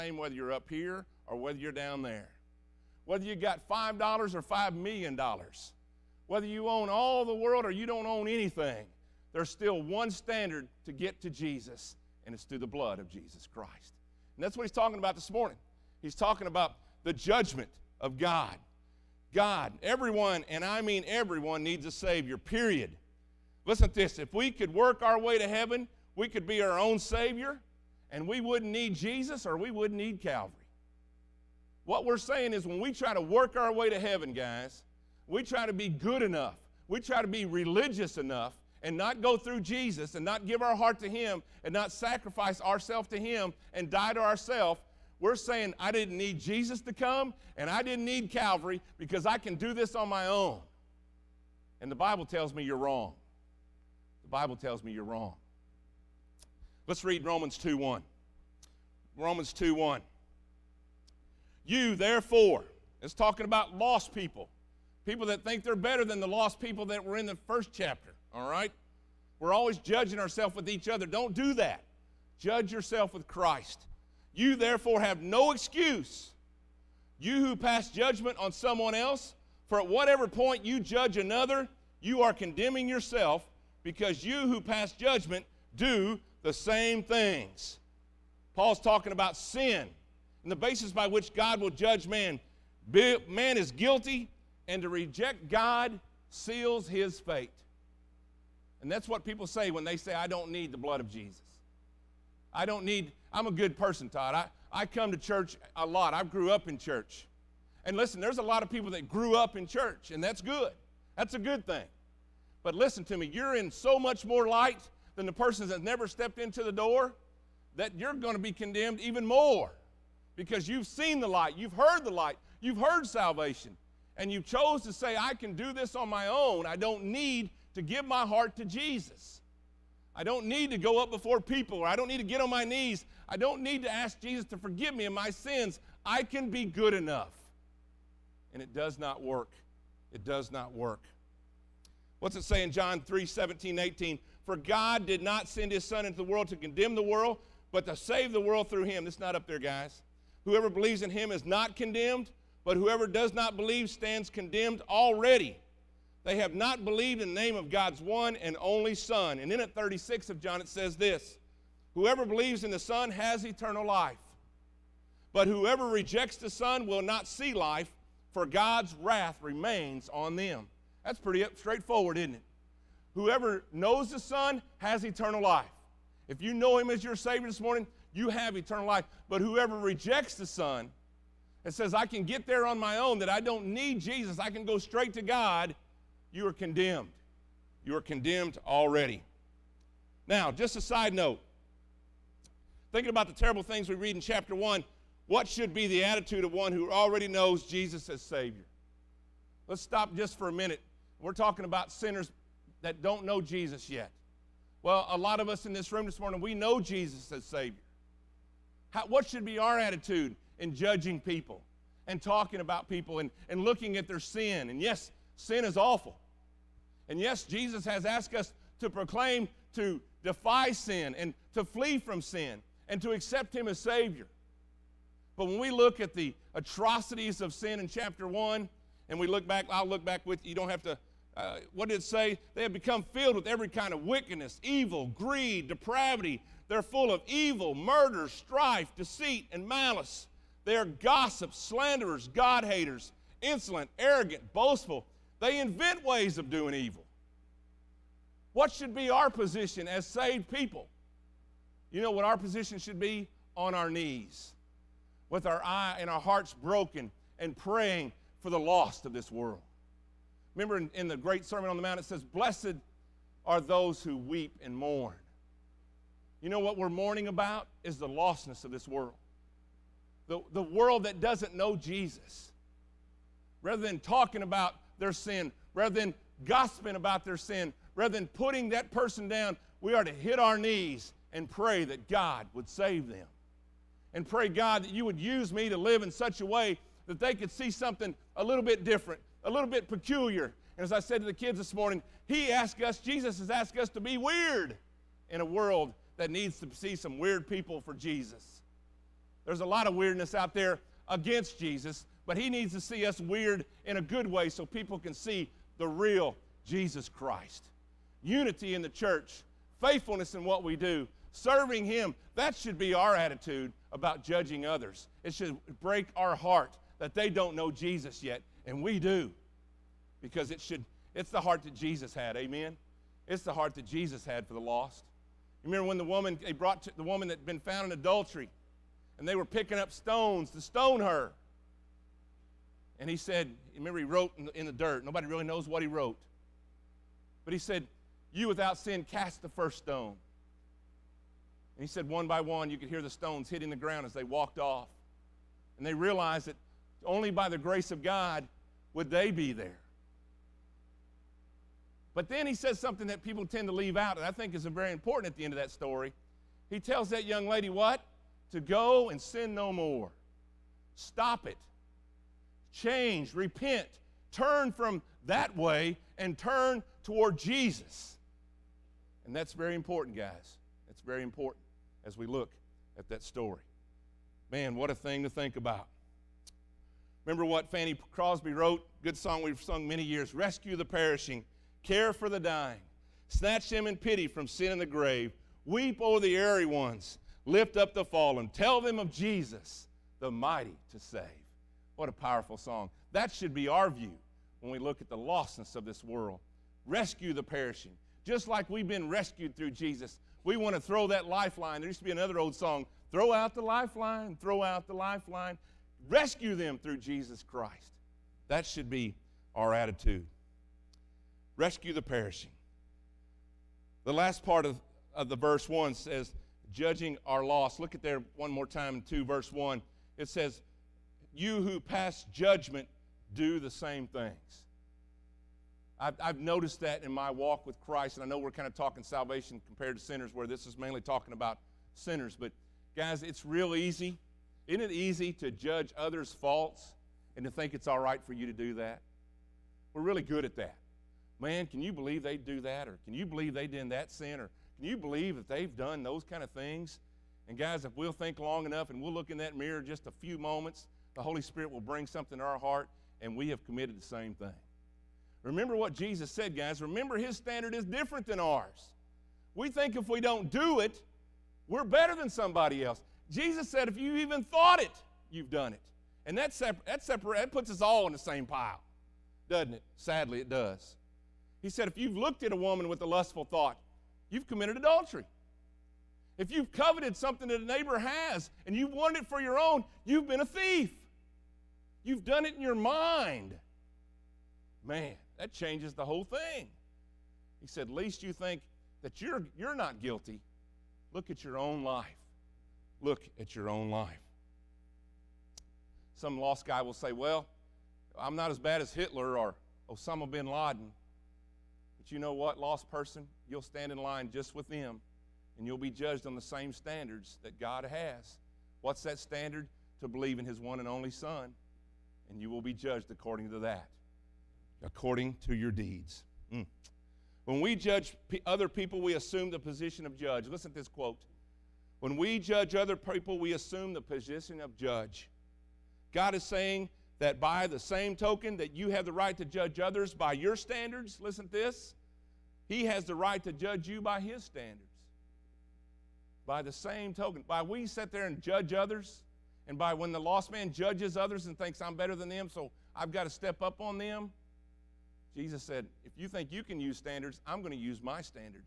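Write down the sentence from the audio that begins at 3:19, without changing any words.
Let's stop just for a minute.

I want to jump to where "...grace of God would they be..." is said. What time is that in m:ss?
5:47.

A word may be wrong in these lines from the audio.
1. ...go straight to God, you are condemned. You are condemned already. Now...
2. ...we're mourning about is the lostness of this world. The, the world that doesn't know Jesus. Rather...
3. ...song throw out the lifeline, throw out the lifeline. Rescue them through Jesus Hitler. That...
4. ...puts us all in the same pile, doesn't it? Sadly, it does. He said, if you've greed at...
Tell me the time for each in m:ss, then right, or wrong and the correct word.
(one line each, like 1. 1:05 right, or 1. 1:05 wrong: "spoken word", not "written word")
1. 3:04 right
2. 4:26 right
3. 6:42 wrong: "Christ", not "Hitler"
4. 7:47 wrong: "looked", not "greed".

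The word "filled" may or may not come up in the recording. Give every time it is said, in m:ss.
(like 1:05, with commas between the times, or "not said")
3:53.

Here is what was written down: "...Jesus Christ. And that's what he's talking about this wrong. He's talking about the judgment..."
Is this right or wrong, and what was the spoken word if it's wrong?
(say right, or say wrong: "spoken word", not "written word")
wrong: "morning", not "wrong".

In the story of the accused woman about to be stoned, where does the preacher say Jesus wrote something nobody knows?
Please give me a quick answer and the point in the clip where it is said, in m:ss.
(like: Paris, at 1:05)
In the dirt, at 5:34.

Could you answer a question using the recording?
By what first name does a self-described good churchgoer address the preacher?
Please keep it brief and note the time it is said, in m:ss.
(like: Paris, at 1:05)
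Todd, at 1:44.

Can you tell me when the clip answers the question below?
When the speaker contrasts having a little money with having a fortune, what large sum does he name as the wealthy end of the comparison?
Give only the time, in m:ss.
0:04.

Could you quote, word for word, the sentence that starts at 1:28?
Paul's talking about sin and the basis by which God will judge man.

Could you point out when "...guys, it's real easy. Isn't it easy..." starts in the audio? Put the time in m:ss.
7:12.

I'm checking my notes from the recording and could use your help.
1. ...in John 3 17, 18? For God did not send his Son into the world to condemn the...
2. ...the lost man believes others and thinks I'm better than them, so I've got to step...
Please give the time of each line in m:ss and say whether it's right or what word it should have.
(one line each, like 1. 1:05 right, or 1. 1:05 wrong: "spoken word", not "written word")
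1. 2:22 right
2. 9:00 wrong: "judges", not "believes".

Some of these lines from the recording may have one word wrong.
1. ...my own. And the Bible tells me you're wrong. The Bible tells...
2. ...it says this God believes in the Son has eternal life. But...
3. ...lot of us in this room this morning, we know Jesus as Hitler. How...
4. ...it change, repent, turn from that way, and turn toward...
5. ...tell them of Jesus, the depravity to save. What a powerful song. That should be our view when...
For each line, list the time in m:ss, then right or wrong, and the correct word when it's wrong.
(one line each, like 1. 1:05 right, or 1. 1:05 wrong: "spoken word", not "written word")
1. 0:50 right
2. 2:40 wrong: "Whoever", not "God"
3. 3:25 wrong: "Savior", not "Hitler"
4. 6:01 right
5. 6:28 wrong: "mighty", not "depravity".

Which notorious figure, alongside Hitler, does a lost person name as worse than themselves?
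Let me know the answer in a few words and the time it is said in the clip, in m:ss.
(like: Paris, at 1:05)
Osama bin Laden, at 8:19.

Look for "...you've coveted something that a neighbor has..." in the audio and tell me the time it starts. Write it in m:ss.
7:56.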